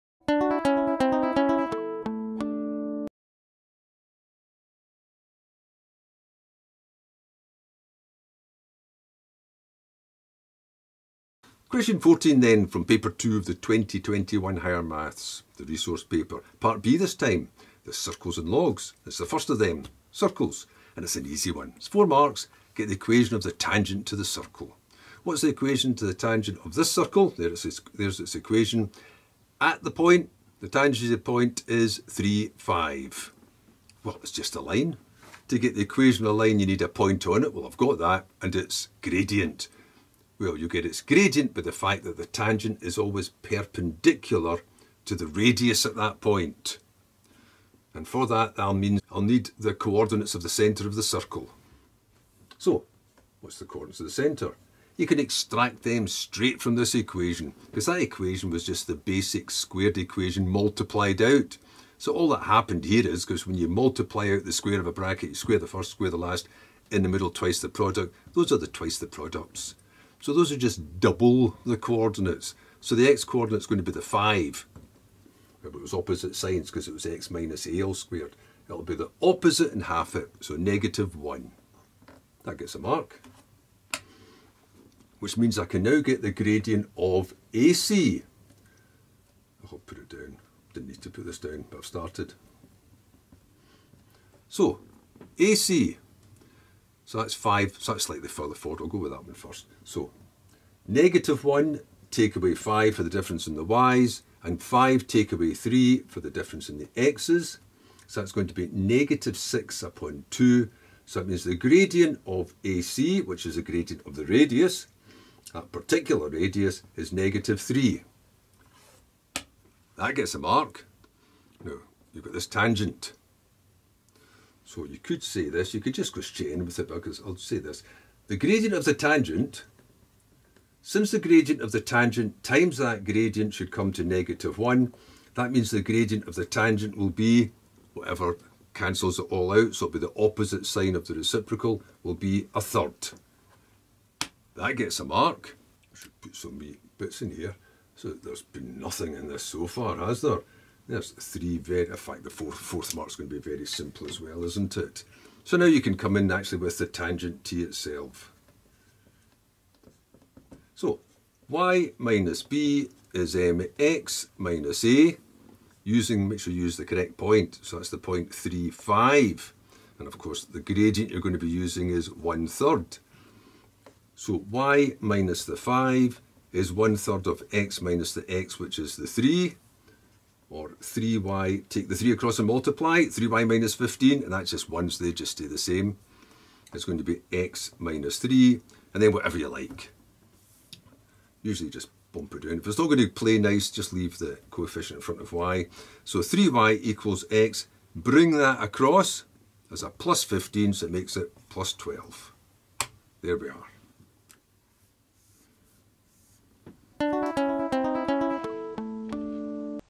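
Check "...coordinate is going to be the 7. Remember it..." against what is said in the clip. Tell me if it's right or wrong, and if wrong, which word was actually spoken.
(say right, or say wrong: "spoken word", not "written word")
wrong: "5", not "7".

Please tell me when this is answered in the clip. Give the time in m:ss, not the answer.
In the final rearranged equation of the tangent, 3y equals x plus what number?
3:21.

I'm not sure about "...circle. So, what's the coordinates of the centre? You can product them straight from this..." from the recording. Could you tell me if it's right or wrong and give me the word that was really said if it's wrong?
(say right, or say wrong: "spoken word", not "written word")
wrong: "extract", not "product".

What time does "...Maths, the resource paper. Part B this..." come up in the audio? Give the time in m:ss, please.
0:14.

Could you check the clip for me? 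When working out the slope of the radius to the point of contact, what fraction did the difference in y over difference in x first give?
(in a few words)
-6/2.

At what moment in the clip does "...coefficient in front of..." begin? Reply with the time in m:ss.
3:14.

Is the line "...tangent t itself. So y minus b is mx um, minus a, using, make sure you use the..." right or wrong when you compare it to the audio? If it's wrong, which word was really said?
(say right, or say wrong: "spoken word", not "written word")
right.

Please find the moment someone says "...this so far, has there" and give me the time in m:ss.
2:29.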